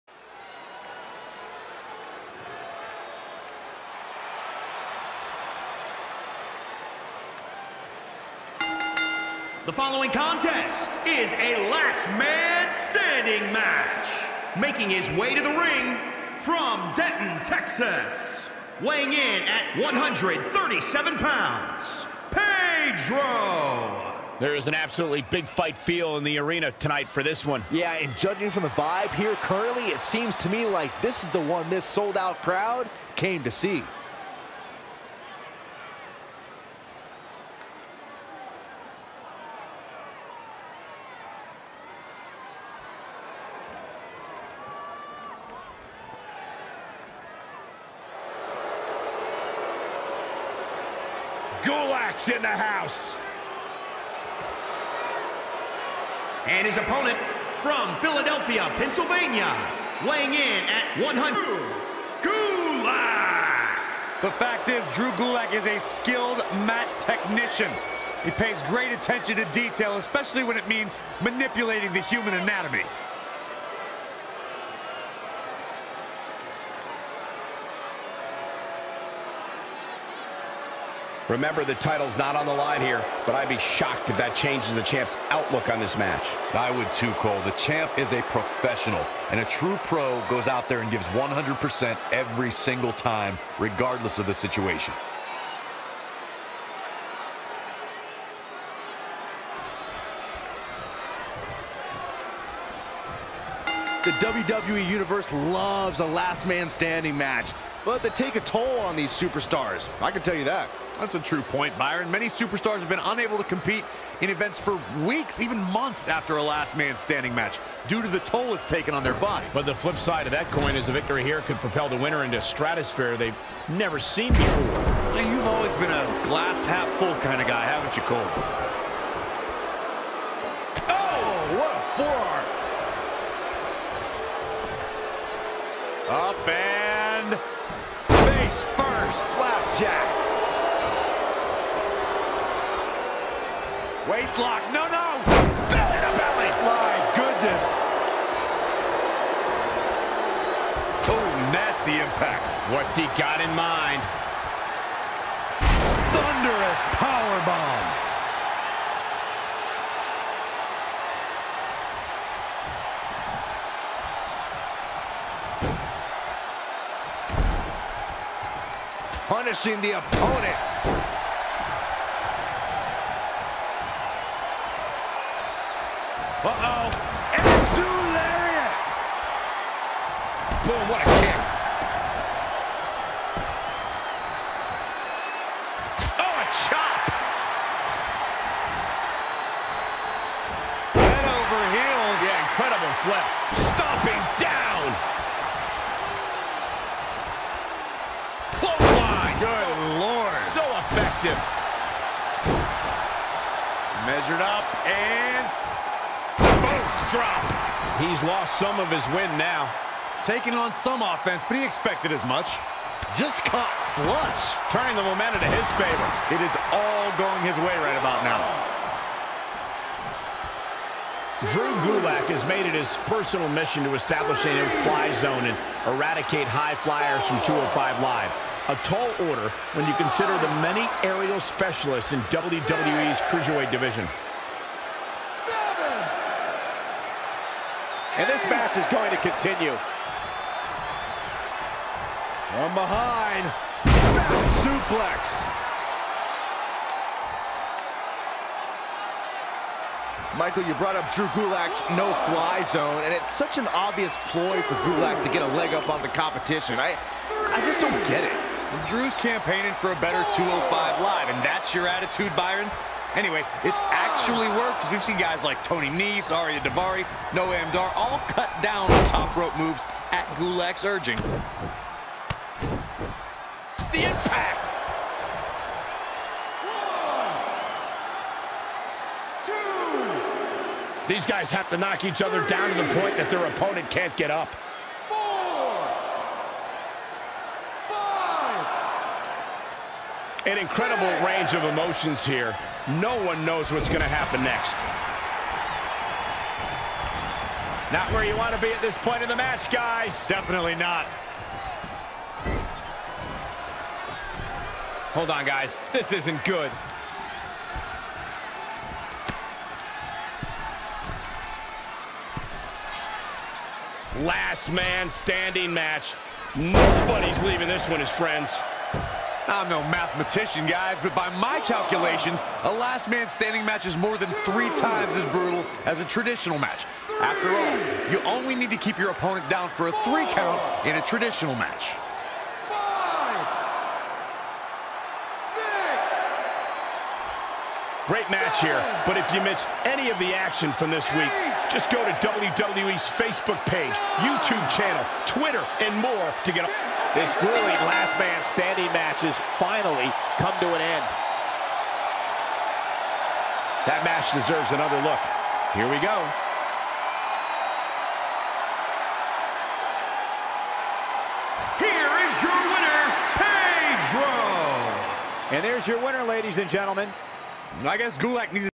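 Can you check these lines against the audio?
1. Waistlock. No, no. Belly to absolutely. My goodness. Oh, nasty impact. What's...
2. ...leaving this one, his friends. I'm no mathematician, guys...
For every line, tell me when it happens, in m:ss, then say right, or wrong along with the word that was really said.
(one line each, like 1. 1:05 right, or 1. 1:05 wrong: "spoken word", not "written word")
1. 2:24 wrong: "belly", not "absolutely"
2. 5:17 right.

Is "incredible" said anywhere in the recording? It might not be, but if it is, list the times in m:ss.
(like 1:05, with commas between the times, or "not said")
3:12, 4:50.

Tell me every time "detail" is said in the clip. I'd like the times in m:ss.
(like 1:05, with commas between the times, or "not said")
1:09.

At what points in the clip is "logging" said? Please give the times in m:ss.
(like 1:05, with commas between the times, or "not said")
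not said.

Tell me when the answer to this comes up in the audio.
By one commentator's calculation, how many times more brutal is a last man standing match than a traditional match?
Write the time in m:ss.
5:24.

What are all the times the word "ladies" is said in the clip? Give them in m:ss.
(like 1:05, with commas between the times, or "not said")
6:06.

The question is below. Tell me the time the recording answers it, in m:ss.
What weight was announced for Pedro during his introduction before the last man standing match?
0:19.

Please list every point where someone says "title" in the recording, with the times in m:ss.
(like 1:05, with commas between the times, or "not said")
1:21.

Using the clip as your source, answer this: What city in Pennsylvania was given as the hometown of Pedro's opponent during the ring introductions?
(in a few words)
Philadelphia.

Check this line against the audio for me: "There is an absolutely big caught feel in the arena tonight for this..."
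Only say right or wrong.
wrong.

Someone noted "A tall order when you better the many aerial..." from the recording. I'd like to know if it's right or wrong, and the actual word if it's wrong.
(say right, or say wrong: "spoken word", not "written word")
wrong: "consider", not "better".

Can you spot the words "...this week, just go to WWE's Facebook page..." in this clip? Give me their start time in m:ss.
5:40.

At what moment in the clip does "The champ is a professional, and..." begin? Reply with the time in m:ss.
1:27.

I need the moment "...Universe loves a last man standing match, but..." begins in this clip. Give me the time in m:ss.
1:44.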